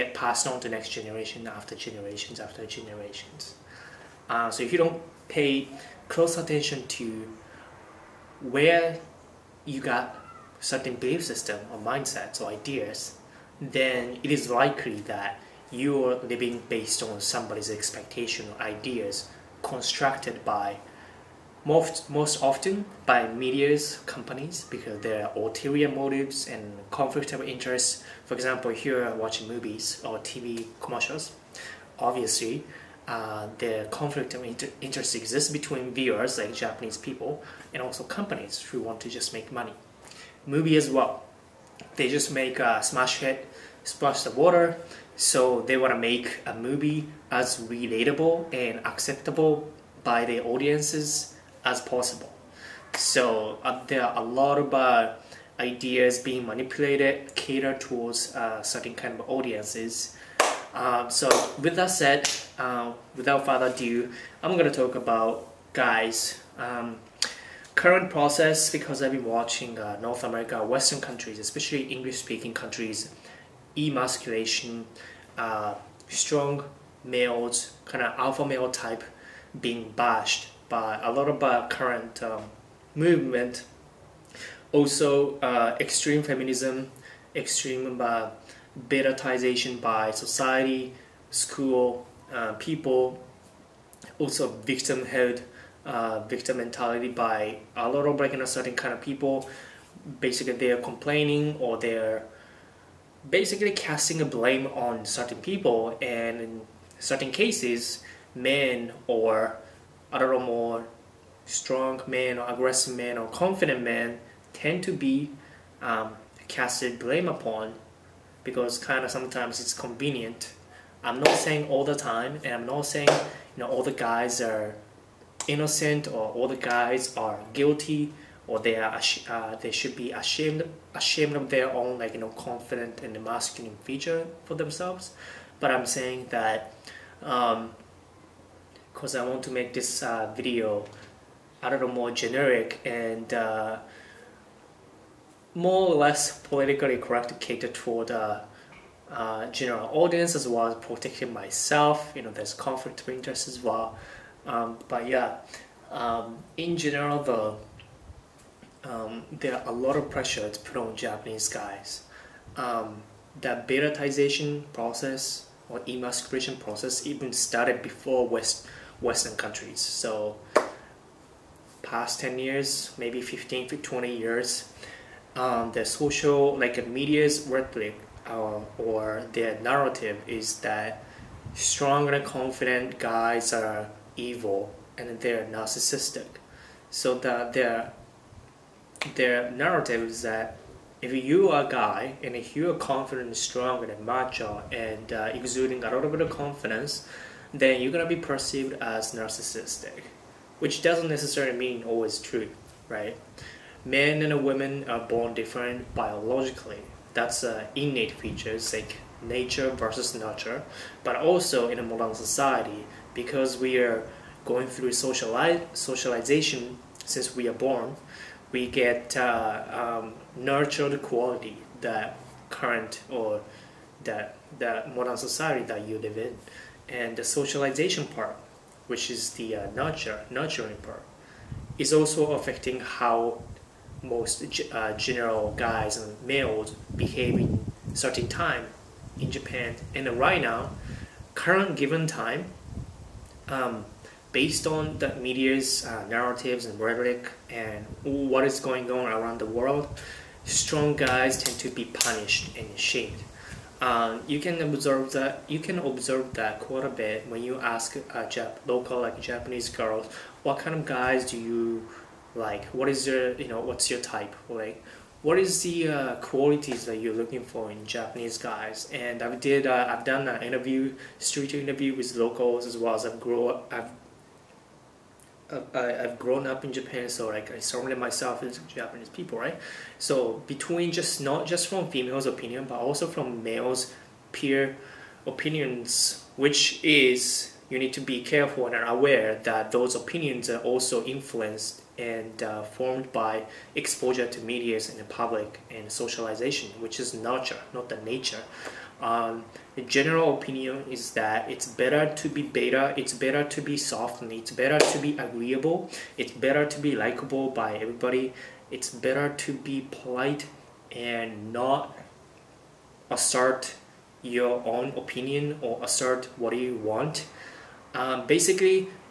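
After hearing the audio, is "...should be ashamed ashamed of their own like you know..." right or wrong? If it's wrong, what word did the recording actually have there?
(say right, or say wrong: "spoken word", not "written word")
right.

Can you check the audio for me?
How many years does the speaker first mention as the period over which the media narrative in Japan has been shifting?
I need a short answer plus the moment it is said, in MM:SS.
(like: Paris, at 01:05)
10 years, at 02:52.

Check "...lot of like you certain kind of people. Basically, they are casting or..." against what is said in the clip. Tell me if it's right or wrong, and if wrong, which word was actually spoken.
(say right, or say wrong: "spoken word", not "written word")
wrong: "complaining", not "casting".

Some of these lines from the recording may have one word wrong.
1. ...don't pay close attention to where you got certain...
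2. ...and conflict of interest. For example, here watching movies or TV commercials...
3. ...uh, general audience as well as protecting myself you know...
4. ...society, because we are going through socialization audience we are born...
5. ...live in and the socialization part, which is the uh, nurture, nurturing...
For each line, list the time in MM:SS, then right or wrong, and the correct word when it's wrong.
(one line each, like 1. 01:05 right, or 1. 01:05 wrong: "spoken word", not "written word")
1. 00:04 right
2. 00:26 right
3. 02:29 right
4. 03:32 wrong: "since", not "audience"
5. 03:45 right.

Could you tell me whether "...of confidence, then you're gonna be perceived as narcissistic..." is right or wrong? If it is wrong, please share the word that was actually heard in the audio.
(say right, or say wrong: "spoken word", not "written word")
right.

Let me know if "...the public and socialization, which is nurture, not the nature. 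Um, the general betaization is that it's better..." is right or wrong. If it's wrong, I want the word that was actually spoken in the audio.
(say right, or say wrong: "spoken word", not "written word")
wrong: "opinion", not "betaization".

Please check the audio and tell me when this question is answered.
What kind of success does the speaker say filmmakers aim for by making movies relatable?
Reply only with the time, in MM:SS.
00:42.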